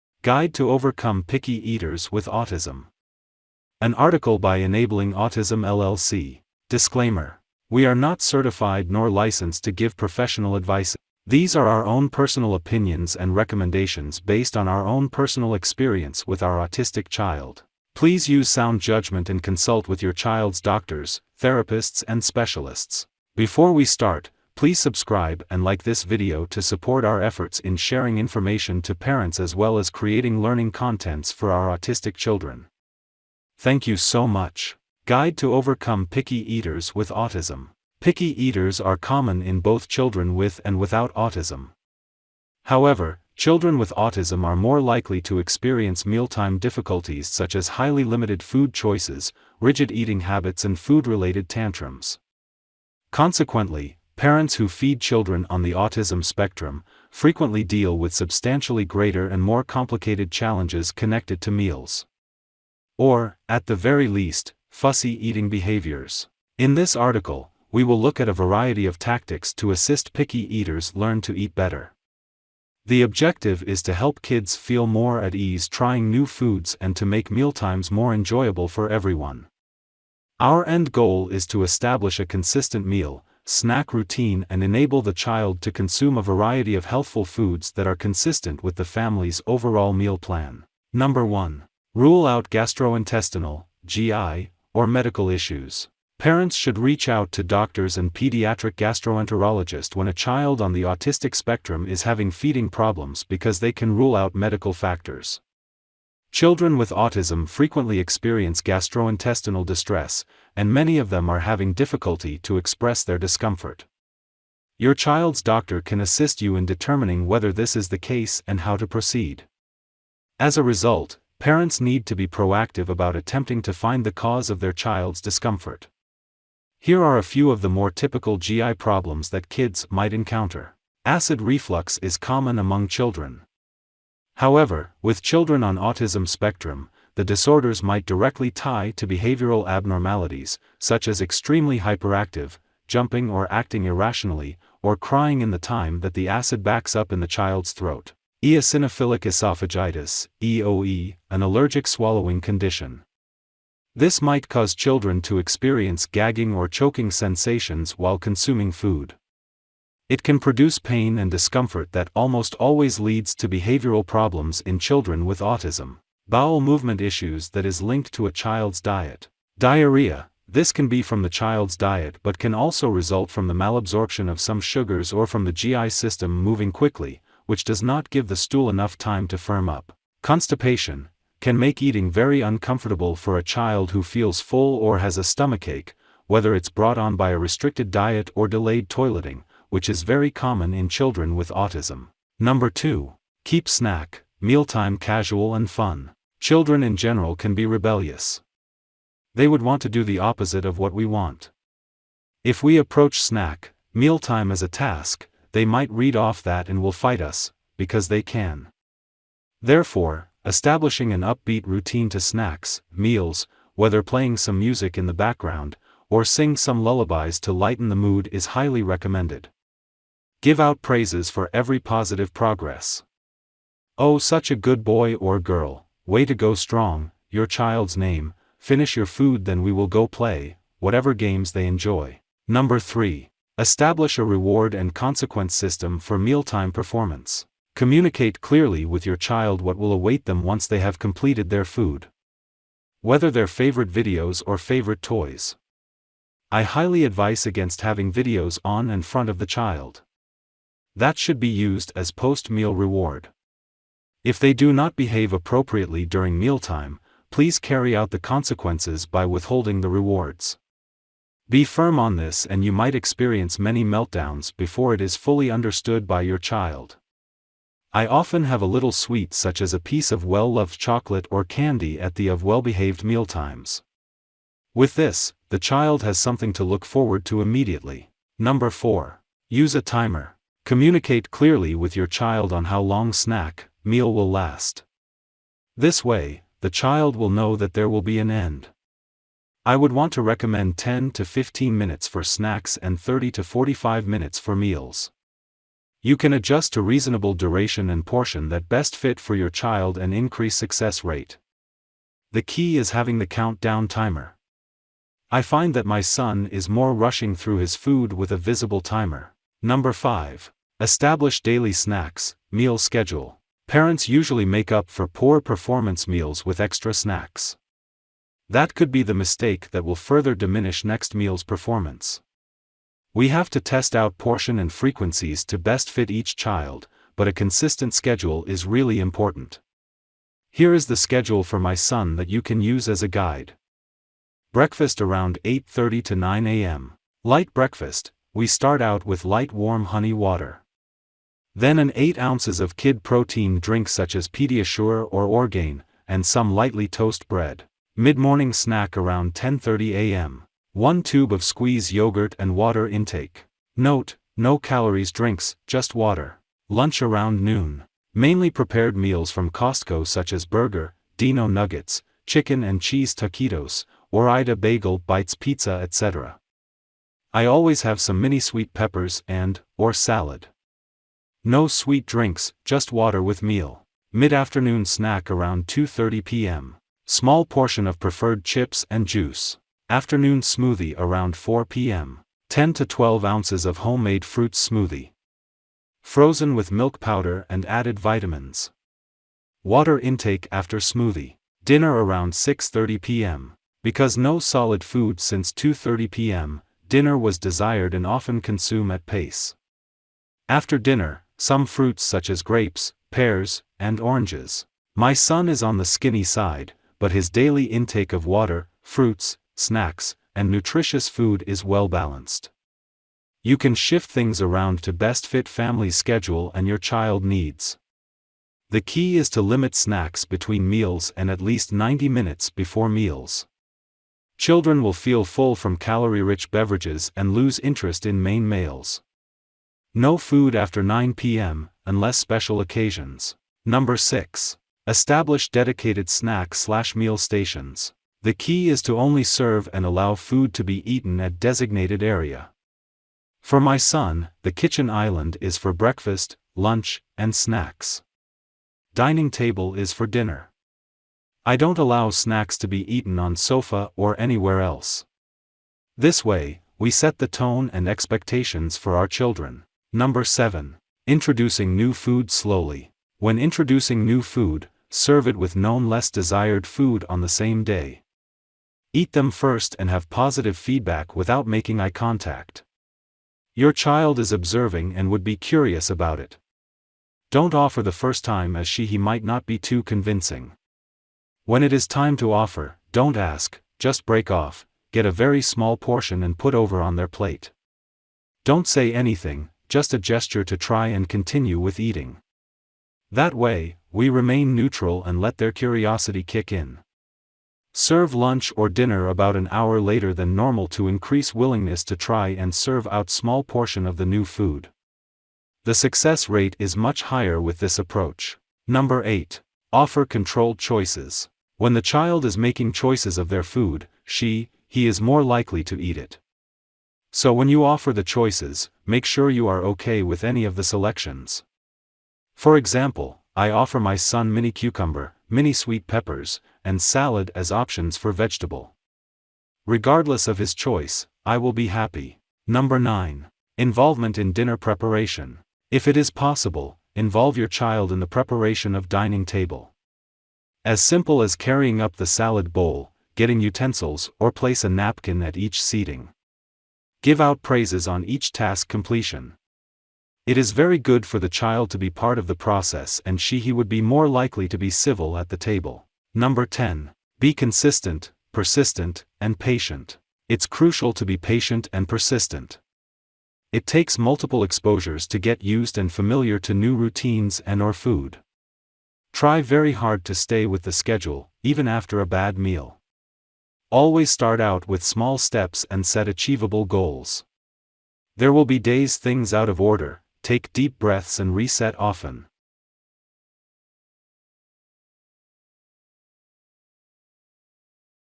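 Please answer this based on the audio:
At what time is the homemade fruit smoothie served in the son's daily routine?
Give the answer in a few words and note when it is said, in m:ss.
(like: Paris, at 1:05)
4 p.m., at 6:21.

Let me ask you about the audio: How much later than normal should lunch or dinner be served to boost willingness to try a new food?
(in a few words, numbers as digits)
About an hour.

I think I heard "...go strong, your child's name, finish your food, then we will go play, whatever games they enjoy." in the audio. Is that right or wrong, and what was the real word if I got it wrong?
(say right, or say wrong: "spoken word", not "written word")
right.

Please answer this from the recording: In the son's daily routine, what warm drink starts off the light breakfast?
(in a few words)
Honey water.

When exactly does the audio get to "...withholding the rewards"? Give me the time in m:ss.
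4:19.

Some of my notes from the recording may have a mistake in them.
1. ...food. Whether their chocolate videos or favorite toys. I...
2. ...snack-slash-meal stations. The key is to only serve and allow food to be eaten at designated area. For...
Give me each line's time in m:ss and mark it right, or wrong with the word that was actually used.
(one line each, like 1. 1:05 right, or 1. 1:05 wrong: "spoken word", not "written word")
1. 4:01 wrong: "favorite", not "chocolate"
2. 7:16 right.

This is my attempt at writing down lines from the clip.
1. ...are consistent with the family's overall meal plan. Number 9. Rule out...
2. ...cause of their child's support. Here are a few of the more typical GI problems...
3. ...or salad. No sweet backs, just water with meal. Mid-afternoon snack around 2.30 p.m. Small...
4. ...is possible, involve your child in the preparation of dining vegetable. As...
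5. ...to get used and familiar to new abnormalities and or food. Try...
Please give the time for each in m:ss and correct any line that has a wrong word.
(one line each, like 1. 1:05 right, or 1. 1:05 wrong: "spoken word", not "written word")
1. 1:27 wrong: "1", not "9"
2. 2:04 wrong: "discomfort", not "support"
3. 6:09 wrong: "drinks", not "backs"
4. 8:55 wrong: "table", not "vegetable"
5. 9:25 wrong: "routines", not "abnormalities".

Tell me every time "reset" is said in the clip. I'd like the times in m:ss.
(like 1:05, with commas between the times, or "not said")
9:41.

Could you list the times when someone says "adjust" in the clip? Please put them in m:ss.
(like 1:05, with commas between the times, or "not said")
4:56.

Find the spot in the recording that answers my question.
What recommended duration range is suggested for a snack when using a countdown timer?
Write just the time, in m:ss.
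4:50.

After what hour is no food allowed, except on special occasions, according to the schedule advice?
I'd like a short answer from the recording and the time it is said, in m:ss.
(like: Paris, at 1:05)
9 p.m., at 7:10.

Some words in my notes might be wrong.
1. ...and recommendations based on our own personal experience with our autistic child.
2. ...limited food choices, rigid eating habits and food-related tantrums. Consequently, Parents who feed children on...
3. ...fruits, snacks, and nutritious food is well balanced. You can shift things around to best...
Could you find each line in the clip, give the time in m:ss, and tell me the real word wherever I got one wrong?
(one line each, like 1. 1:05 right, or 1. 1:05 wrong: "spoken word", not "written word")
1. 0:13 right
2. 0:48 right
3. 6:48 right.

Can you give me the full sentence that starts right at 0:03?
An article by Enabling Autism LLC.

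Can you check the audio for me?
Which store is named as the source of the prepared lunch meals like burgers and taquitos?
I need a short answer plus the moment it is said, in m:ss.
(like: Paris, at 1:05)
Costco, at 5:59.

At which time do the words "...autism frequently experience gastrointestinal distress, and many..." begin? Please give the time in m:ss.
1:46.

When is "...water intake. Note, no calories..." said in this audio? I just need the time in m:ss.
5:52.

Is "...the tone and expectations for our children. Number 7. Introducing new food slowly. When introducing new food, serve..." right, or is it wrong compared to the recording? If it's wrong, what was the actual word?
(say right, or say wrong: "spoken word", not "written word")
right.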